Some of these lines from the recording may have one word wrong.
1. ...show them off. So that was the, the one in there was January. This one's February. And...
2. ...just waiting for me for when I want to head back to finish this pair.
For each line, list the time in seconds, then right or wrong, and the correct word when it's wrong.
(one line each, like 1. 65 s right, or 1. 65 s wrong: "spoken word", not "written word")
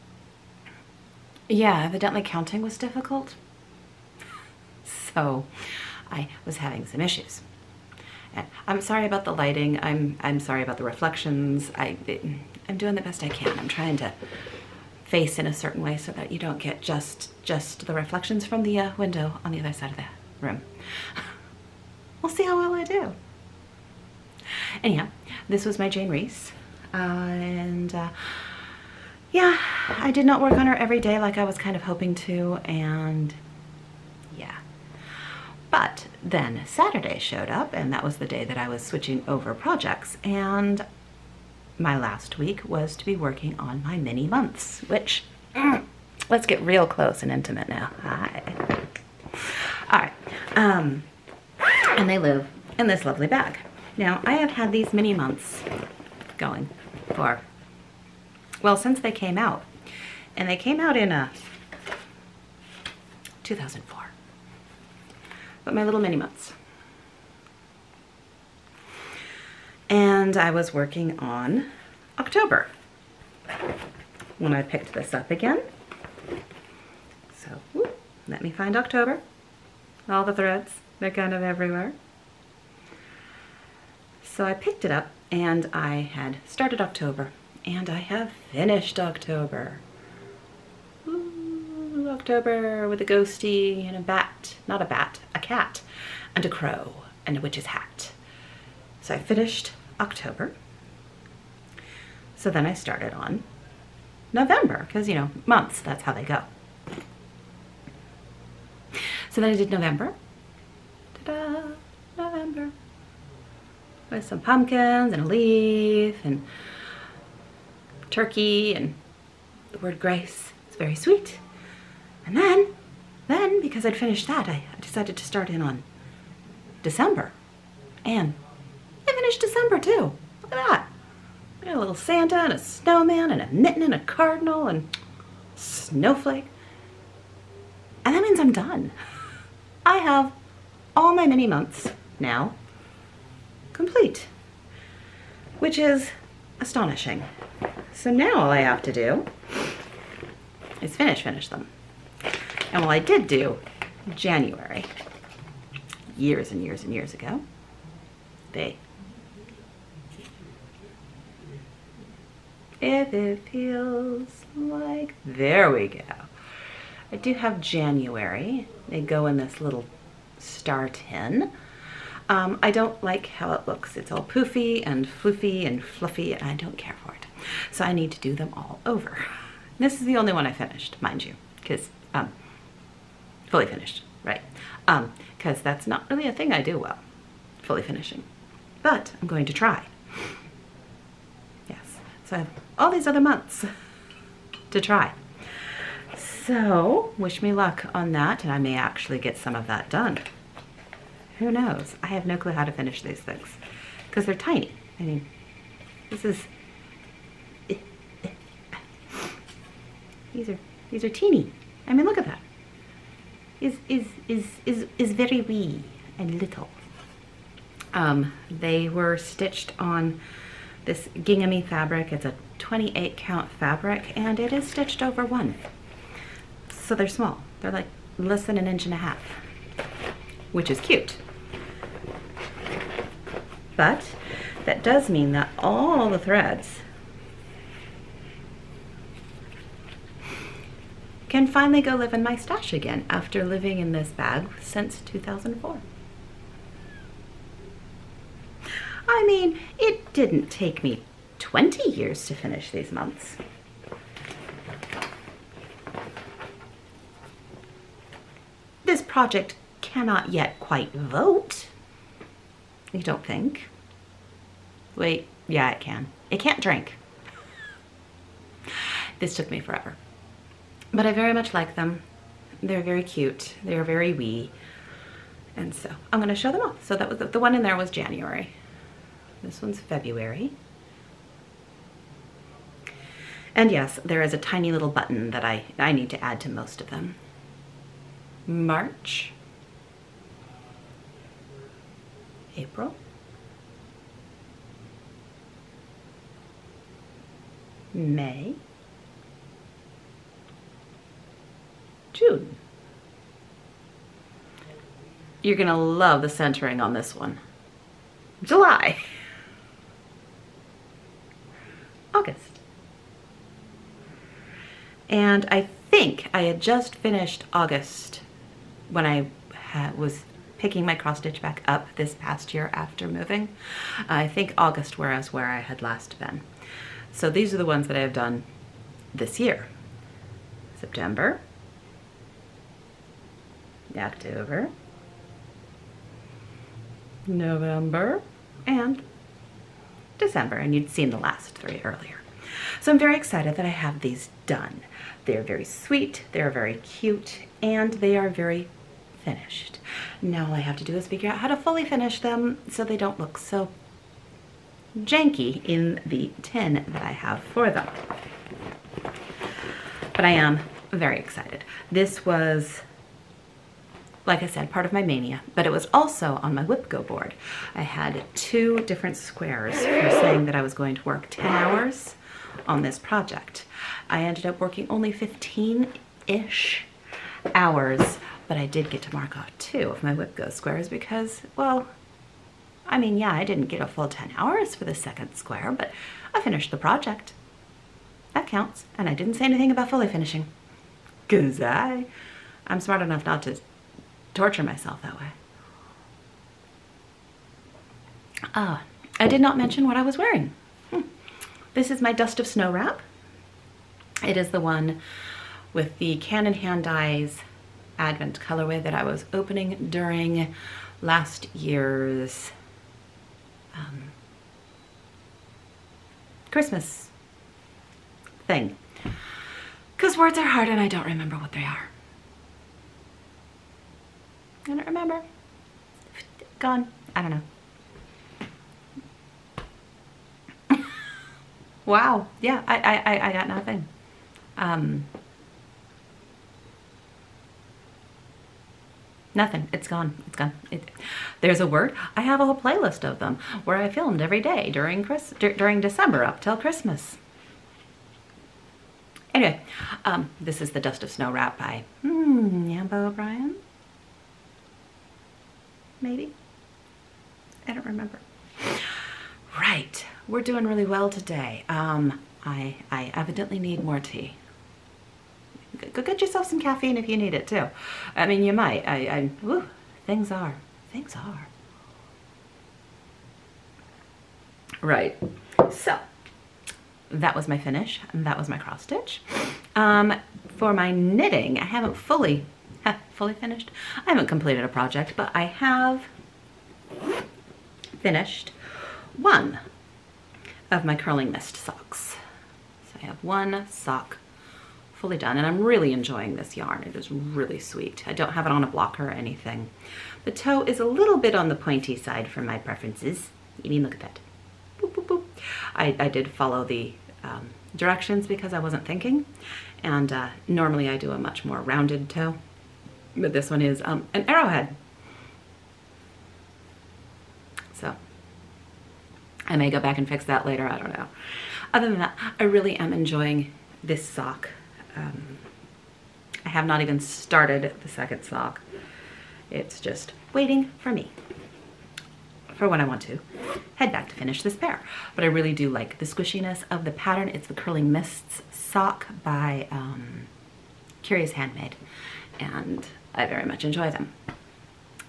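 1. 276 s right
2. 529 s right.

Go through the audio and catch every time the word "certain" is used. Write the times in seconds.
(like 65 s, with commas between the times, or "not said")
15 s.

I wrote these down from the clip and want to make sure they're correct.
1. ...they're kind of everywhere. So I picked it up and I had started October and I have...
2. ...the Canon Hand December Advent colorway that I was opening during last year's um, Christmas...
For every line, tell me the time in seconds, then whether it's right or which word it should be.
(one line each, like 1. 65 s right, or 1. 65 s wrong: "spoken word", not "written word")
1. 80 s right
2. 405 s wrong: "Dyes", not "December".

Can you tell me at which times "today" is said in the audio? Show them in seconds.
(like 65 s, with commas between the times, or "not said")
461 s.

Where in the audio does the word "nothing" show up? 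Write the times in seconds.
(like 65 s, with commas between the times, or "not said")
433 s, 439 s.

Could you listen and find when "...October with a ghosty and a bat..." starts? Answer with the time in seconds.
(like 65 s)
92 s.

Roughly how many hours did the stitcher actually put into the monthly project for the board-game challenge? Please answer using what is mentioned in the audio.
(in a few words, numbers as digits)
15.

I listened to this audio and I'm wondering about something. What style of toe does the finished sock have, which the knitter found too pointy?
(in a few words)
arrowhead.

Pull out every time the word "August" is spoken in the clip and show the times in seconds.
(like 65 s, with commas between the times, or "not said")
312 s, 317 s, 324 s.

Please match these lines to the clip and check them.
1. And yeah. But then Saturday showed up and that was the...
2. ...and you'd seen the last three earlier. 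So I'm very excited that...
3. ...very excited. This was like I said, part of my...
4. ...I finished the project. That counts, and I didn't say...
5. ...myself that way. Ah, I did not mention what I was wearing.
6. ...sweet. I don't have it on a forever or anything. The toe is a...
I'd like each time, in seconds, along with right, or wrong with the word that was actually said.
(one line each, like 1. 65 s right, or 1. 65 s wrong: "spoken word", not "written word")
1. 32 s right
2. 340 s right
3. 360 s right
4. 386 s right
5. 394 s right
6. 497 s wrong: "blocker", not "forever".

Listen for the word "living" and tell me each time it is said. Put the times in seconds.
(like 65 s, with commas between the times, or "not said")
243 s.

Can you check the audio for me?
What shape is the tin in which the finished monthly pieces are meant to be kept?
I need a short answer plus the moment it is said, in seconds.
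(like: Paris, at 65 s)
star, at 170 s.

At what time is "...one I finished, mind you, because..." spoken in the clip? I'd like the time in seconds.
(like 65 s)
180 s.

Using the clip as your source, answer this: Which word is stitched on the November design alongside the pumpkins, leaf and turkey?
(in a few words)
grace.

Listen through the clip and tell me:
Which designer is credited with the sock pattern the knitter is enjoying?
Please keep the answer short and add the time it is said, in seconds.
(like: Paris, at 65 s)
Curious Handmade, at 541 s.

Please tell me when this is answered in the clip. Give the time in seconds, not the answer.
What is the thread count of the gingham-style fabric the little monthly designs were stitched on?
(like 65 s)
222 s.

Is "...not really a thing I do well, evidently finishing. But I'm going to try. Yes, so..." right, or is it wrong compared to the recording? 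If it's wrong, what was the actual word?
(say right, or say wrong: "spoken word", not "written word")
wrong: "fully", not "evidently".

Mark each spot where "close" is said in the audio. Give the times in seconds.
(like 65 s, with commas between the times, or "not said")
46 s.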